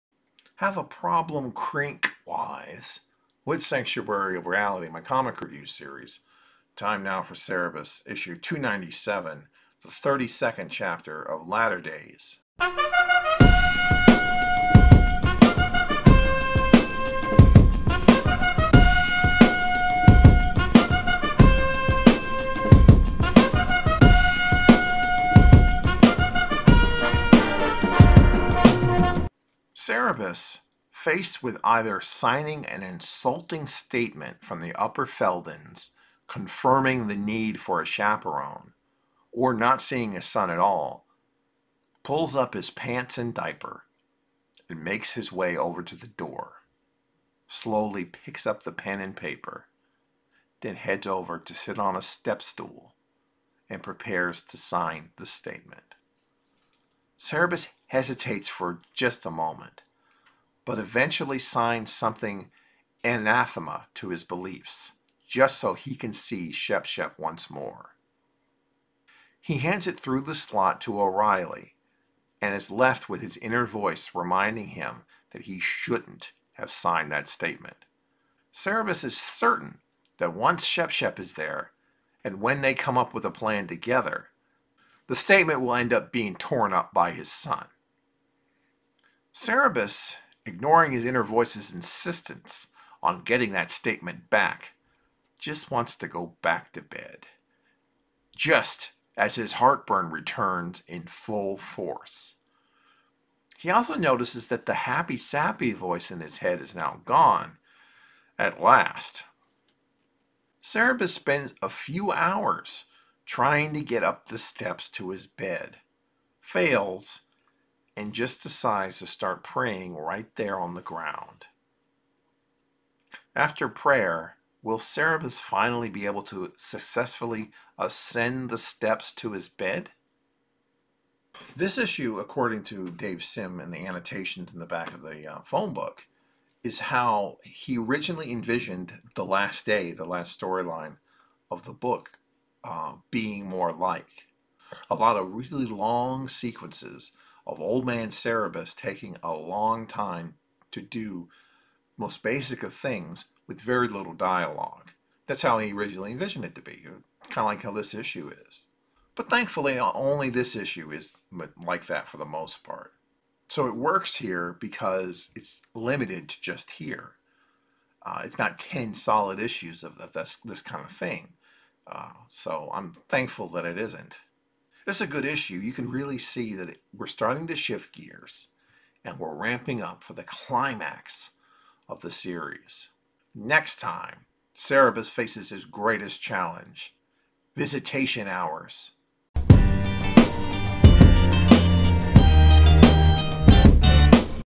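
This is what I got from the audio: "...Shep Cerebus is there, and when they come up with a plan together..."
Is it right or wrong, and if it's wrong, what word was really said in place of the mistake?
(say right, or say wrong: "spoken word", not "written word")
wrong: "Shep", not "Cerebus".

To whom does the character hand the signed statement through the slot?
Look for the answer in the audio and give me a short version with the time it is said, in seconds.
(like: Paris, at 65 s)
O'Reilly, at 71 s.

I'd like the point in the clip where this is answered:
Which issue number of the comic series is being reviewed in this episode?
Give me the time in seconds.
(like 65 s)
8 s.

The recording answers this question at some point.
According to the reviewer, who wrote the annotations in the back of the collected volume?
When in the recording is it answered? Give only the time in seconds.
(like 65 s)
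132 s.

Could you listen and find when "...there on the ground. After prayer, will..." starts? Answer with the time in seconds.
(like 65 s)
120 s.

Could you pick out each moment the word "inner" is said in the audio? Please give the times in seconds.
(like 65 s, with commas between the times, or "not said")
73 s, 91 s.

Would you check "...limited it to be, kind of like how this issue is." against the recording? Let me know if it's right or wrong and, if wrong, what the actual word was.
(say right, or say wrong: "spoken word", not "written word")
wrong: "envisioned", not "limited".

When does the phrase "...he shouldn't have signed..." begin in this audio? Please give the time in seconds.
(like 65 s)
75 s.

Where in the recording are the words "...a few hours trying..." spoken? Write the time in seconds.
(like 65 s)
111 s.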